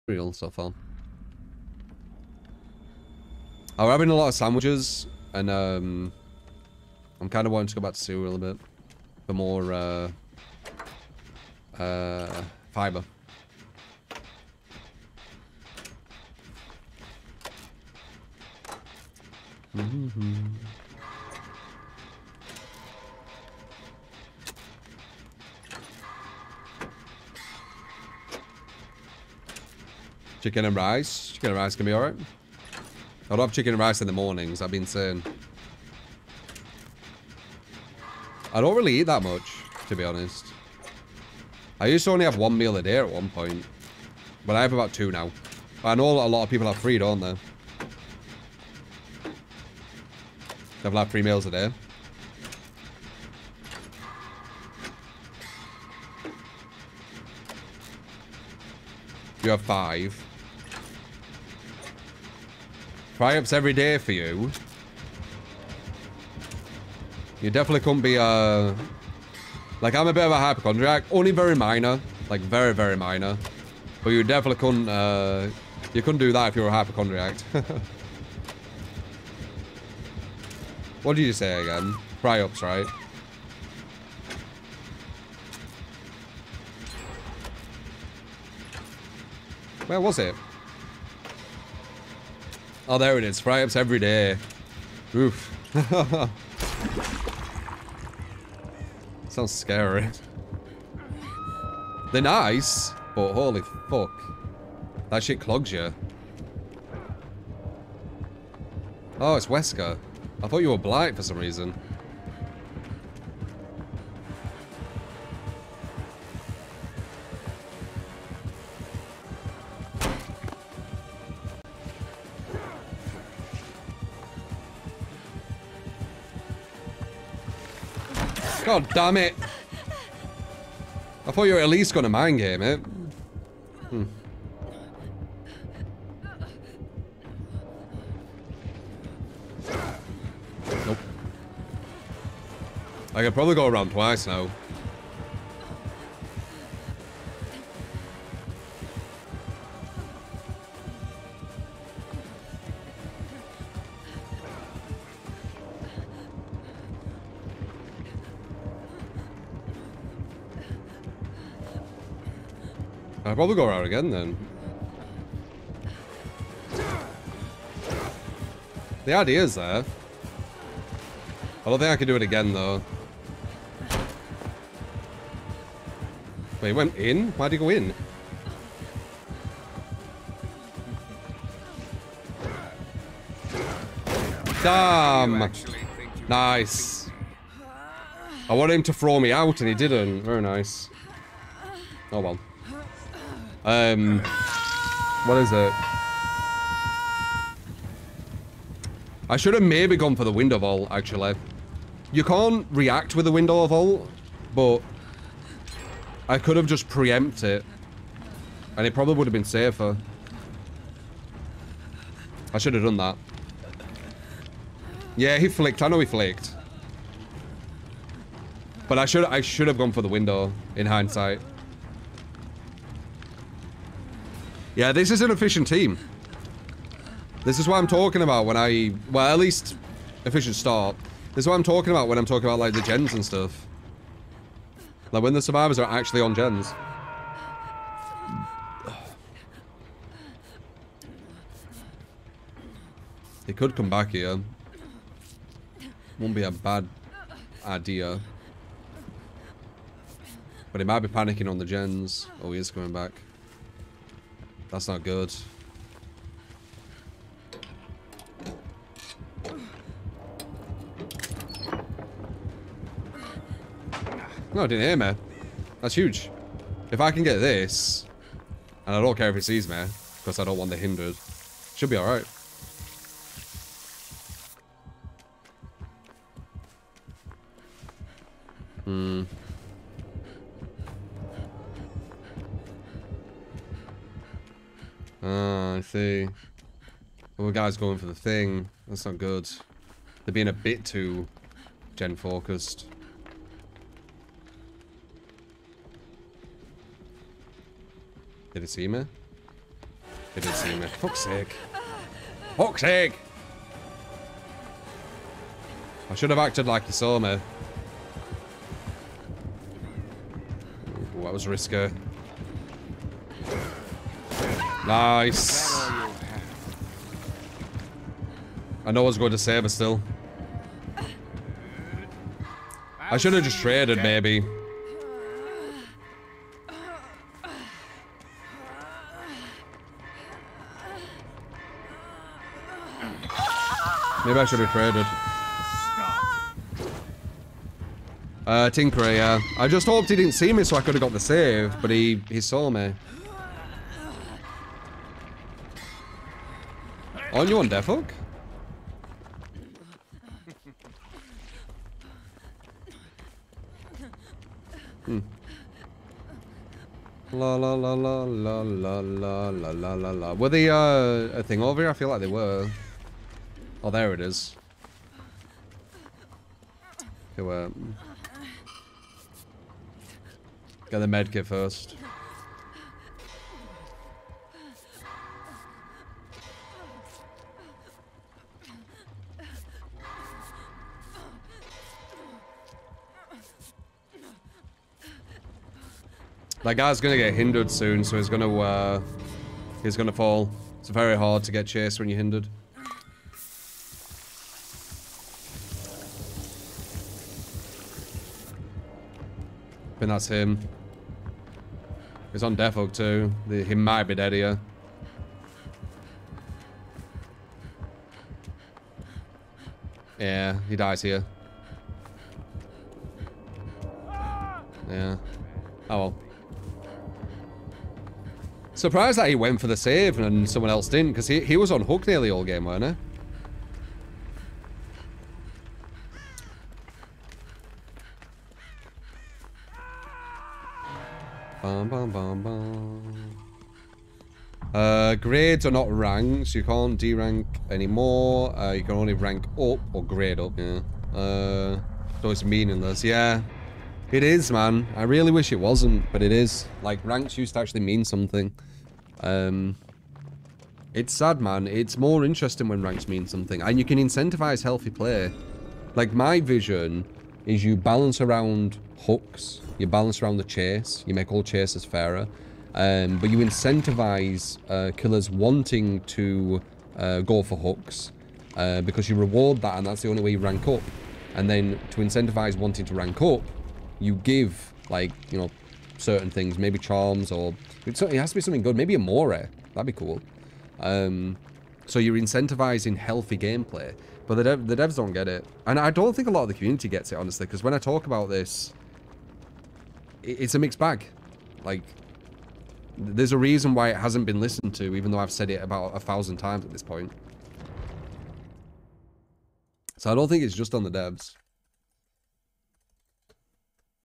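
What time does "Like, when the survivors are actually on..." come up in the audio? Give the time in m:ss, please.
3:55.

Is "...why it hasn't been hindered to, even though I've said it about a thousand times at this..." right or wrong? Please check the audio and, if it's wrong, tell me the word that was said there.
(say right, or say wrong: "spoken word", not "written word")
wrong: "listened", not "hindered".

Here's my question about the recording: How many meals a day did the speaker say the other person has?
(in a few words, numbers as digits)
5.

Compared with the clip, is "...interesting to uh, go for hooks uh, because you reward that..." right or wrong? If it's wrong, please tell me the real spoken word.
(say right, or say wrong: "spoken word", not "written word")
wrong: "wanting", not "interesting".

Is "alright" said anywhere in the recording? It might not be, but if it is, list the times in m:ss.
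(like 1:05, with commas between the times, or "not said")
0:31, 4:31.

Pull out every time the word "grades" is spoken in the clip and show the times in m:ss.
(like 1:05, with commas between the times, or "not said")
7:15, 7:20.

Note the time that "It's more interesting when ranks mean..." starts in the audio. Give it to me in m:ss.
7:31.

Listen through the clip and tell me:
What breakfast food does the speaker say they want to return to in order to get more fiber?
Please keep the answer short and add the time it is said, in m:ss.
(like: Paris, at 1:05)
Cereal, at 0:07.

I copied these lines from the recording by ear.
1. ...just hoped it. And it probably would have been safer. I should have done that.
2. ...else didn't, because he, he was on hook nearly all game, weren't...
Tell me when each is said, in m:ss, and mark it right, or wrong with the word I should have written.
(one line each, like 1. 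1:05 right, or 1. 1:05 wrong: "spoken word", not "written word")
1. 3:26 wrong: "preempted", not "hoped"
2. 7:00 right.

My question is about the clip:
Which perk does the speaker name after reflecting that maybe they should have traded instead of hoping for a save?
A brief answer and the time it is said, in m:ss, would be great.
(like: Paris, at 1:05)
Tinkerer, at 5:38.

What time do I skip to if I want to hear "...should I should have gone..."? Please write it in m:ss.
3:39.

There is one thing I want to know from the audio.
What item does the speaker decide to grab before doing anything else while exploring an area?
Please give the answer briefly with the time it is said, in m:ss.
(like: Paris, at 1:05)
Medkit, at 6:11.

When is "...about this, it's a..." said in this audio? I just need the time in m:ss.
8:08.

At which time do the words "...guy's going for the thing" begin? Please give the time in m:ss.
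4:47.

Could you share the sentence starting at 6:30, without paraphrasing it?
It's very hard to get chased when you're hindered.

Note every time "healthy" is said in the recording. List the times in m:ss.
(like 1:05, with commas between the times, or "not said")
7:34, 8:02.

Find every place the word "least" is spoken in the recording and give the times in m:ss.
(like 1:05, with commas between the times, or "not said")
2:11, 3:49.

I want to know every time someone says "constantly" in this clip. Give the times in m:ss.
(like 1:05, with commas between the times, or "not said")
not said.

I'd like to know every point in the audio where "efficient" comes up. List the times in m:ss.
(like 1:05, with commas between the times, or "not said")
3:45, 3:50.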